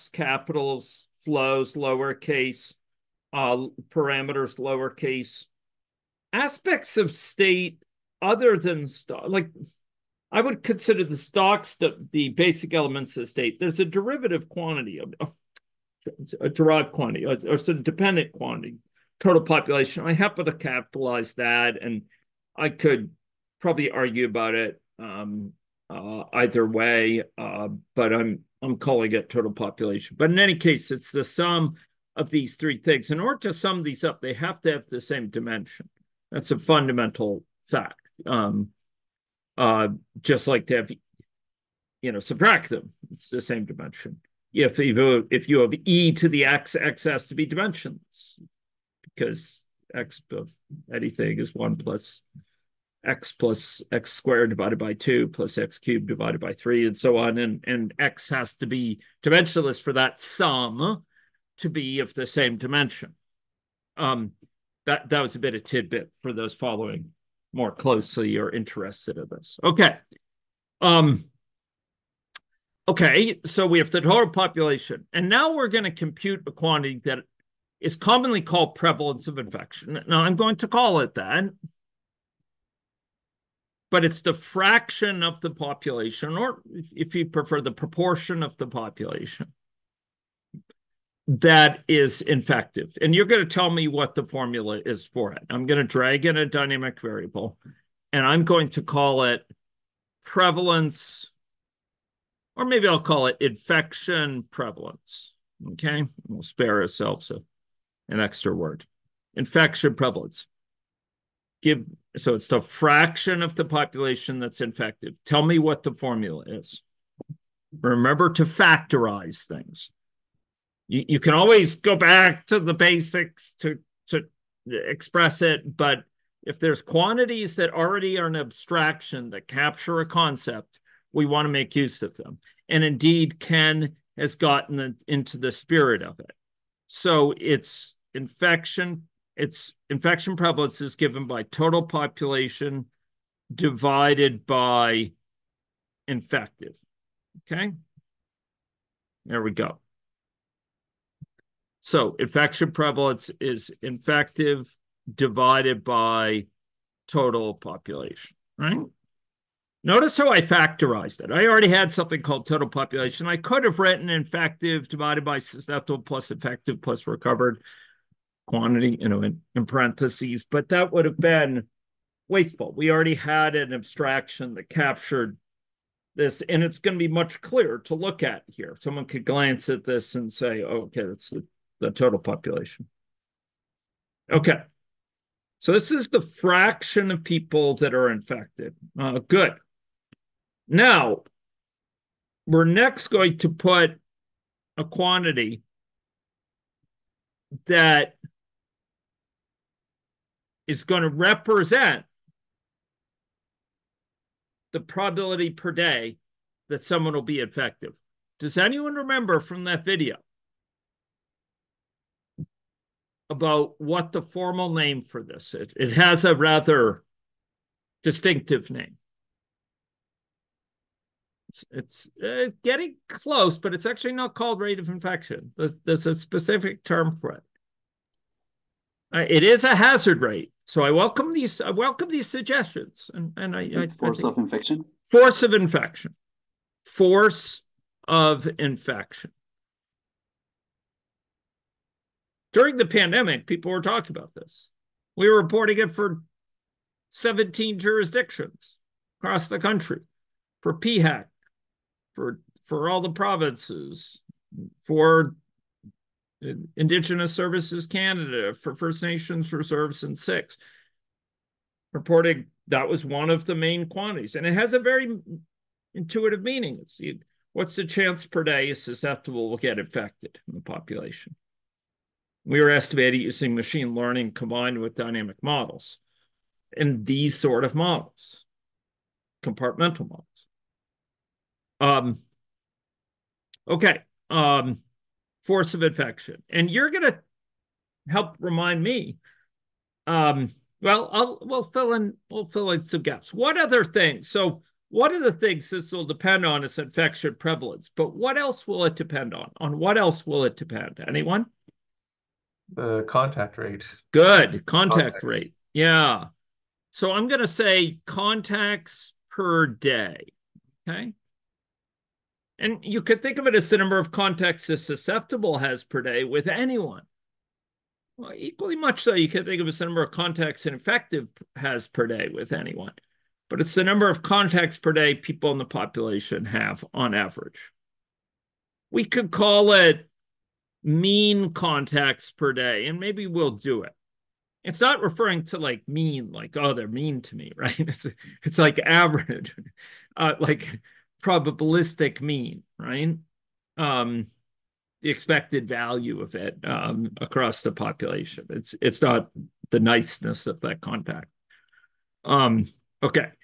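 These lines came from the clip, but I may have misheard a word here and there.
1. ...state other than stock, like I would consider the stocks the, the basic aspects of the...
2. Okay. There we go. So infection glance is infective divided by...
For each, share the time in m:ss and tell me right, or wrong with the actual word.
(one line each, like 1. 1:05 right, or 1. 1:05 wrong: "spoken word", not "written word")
1. 0:07 wrong: "elements", not "aspects"
2. 2:27 wrong: "prevalence", not "glance".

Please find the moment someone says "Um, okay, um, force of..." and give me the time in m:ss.
4:41.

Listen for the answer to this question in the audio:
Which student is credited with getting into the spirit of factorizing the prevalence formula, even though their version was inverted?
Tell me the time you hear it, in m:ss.
2:13.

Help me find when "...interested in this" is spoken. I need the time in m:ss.
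1:08.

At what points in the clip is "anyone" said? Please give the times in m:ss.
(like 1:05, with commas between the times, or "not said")
3:28, 5:01, 5:16, 5:22.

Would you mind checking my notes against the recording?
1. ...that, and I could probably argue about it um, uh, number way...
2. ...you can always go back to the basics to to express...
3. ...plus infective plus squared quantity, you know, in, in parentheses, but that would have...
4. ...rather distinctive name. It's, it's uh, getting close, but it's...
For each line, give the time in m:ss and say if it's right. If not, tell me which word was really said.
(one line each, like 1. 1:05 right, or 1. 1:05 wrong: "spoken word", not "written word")
1. 0:21 wrong: "either", not "number"
2. 2:01 right
3. 2:46 wrong: "recovered", not "squared"
4. 3:36 right.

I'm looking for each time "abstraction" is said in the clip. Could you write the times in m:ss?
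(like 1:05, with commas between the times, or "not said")
2:08, 2:53.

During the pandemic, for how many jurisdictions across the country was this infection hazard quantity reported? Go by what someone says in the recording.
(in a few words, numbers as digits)
17.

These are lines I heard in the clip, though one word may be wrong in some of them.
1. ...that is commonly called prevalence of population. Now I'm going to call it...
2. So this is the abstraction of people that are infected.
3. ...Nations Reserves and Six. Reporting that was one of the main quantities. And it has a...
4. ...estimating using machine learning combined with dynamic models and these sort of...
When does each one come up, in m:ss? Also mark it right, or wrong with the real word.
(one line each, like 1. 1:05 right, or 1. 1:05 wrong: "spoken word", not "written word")
1. 1:17 wrong: "infection", not "population"
2. 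3:05 wrong: "fraction", not "abstraction"
3. 4:19 right
4. 4:32 right.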